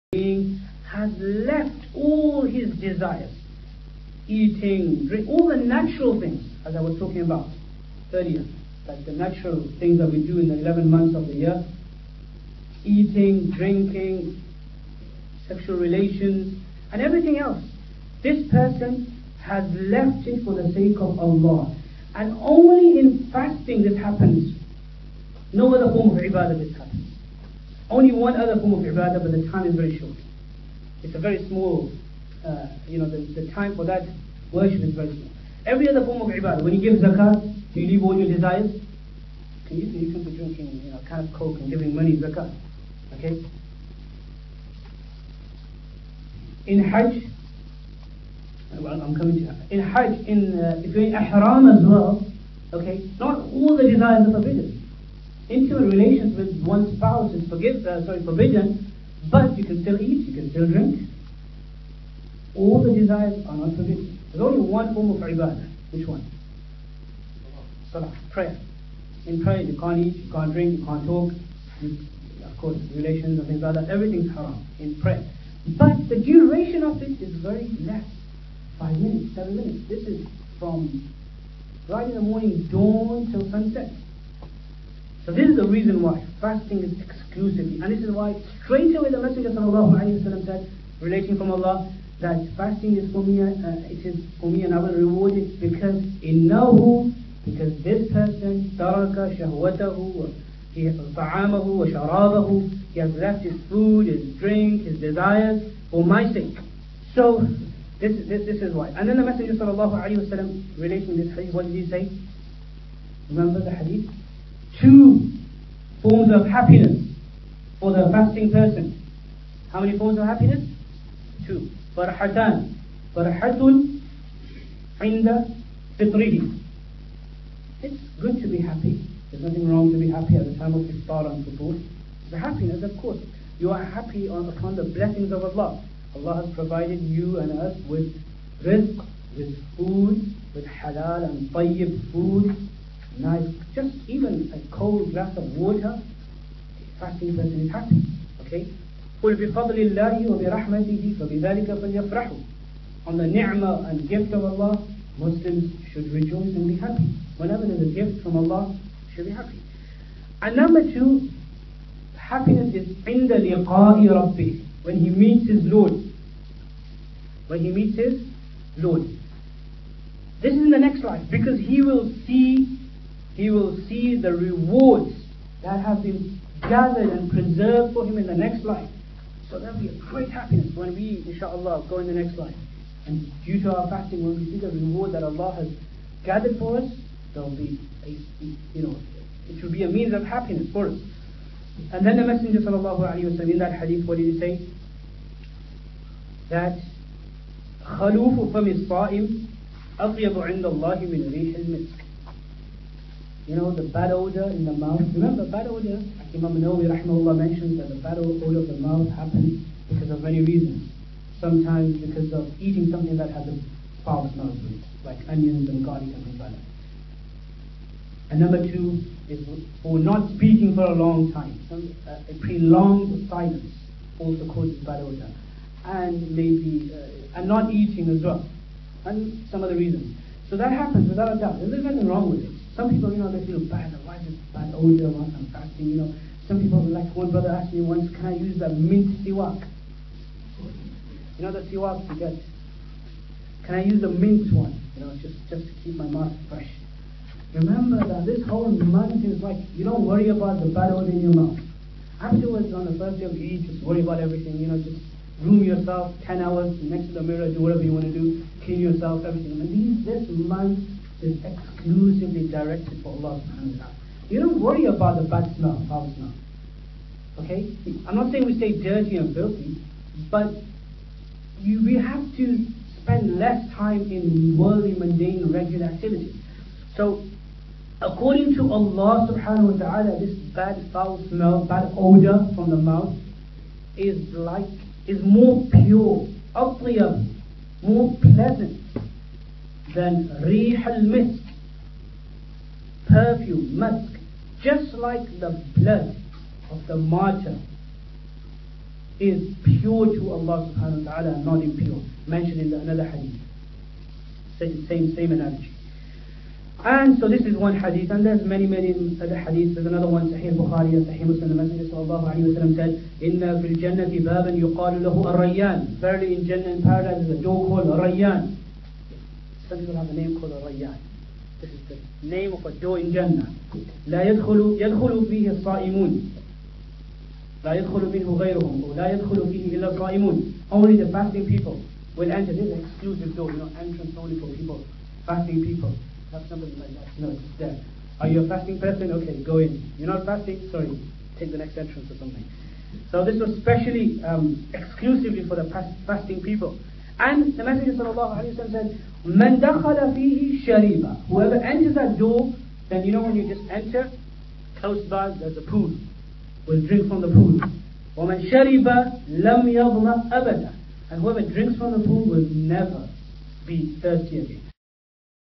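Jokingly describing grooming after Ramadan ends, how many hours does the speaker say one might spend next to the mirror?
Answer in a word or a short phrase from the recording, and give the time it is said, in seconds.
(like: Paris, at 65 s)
10, at 256 s.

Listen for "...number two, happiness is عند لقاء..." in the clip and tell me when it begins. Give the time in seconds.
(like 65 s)
160 s.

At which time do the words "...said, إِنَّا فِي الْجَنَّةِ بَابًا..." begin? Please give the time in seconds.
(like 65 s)
312 s.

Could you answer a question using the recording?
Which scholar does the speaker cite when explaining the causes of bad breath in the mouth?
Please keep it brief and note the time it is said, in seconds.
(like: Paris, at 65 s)
Imam Nawawi, at 206 s.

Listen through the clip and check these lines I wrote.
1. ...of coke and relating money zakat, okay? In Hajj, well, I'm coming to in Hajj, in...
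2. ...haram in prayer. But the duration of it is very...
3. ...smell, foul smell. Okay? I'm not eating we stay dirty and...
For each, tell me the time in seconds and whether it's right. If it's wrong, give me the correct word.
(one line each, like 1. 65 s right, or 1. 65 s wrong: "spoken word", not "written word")
1. 41 s wrong: "giving", not "relating"
2. 74 s right
3. 265 s wrong: "saying", not "eating".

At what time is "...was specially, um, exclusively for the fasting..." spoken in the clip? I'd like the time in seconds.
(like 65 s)
343 s.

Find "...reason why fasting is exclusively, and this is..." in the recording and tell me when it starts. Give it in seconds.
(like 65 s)
85 s.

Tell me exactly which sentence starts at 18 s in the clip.
This person has left it for the sake of Allah.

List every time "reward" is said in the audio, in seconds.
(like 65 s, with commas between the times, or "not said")
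94 s, 174 s, 184 s.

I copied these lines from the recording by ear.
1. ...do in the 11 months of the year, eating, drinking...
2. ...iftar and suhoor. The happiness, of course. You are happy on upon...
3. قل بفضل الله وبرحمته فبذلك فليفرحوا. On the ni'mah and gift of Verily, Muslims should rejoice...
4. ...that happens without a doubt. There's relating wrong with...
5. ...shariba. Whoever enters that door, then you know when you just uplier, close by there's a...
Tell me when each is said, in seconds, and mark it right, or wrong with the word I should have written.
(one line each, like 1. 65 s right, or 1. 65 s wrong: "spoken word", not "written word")
1. 10 s right
2. 130 s right
3. 149 s wrong: "Allah", not "Verily"
4. 230 s wrong: "nothing", not "relating"
5. 350 s wrong: "enter", not "uplier".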